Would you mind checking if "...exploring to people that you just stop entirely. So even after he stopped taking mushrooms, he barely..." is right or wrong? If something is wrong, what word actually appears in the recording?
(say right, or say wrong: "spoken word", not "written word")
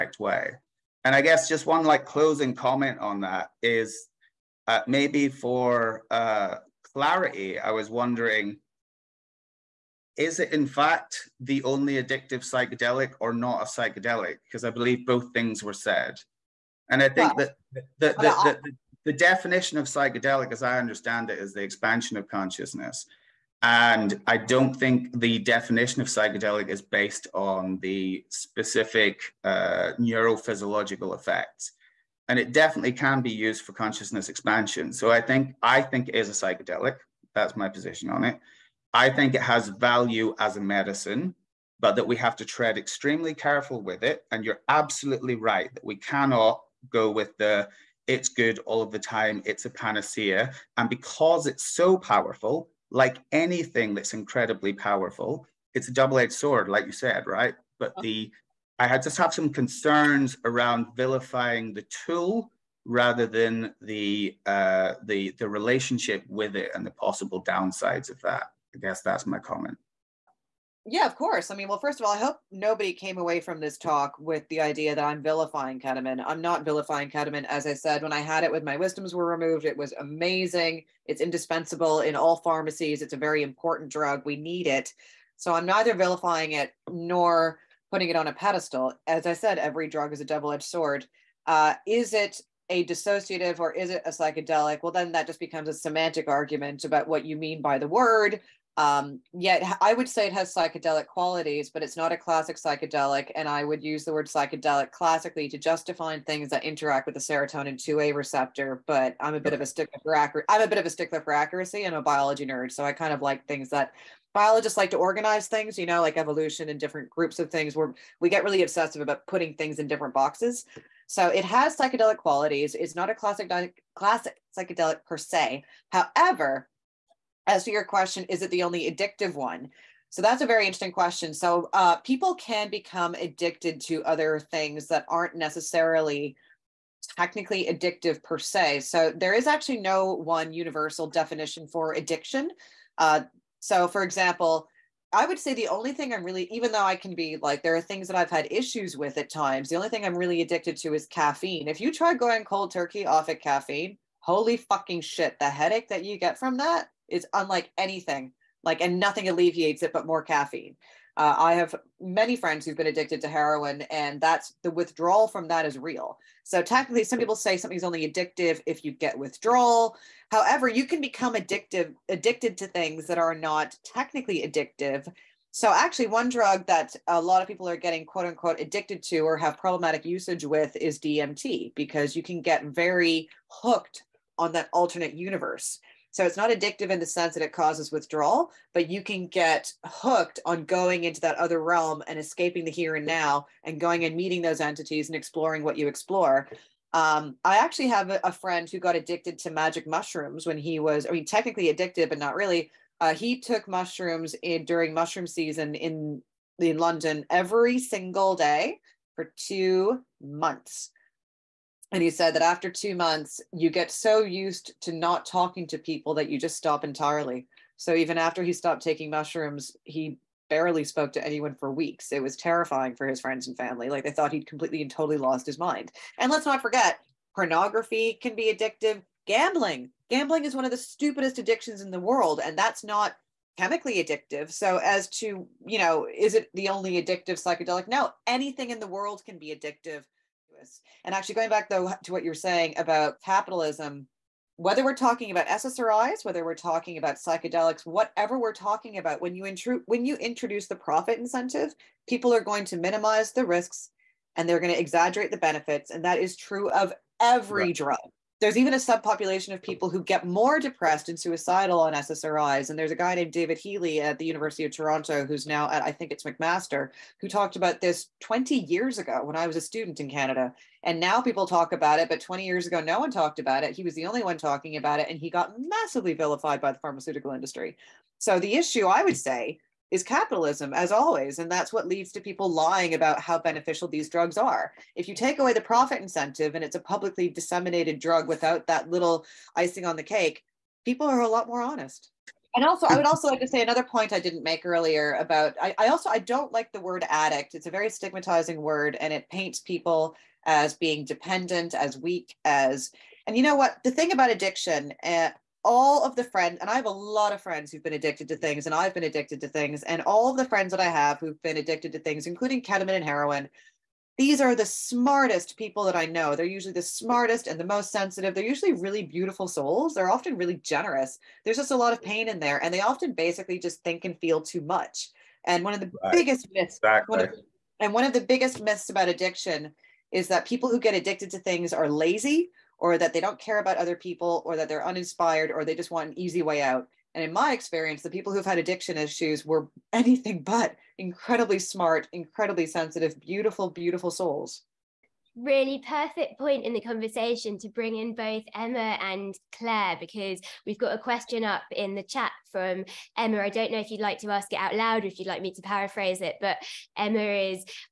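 wrong: "talking", not "exploring".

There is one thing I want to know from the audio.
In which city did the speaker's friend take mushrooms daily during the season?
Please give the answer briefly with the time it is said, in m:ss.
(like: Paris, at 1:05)
London, at 3:26.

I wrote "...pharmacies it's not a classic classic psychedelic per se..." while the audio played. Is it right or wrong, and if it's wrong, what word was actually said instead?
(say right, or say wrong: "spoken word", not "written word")
wrong: "qualities", not "pharmacies".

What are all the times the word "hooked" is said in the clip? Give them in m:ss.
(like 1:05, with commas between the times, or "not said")
3:03, 3:09.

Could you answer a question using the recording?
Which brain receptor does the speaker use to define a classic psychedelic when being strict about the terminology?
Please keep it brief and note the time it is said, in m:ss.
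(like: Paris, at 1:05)
serotonin 2a receptor, at 1:47.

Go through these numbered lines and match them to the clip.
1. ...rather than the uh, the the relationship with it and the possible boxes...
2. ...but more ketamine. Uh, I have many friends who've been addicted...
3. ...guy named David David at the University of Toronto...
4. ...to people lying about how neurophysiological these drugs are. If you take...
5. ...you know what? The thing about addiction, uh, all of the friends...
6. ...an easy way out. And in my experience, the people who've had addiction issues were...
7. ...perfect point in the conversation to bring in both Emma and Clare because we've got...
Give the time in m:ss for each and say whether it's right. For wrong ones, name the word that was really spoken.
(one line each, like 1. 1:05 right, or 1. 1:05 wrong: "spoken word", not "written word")
1. 1:02 wrong: "downsides", not "boxes"
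2. 2:39 wrong: "caffeine", not "ketamine"
3. 4:22 wrong: "Healy", not "David"
4. 4:42 wrong: "beneficial", not "neurophysiological"
5. 5:03 right
6. 5:36 right
7. 5:45 right.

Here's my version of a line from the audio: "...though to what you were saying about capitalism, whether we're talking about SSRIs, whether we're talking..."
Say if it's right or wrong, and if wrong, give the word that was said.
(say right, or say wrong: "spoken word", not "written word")
right.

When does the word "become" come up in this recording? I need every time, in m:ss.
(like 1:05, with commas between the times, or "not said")
1:35, 2:12, 2:51.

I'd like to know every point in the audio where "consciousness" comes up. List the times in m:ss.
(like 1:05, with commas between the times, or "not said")
0:22, 0:33.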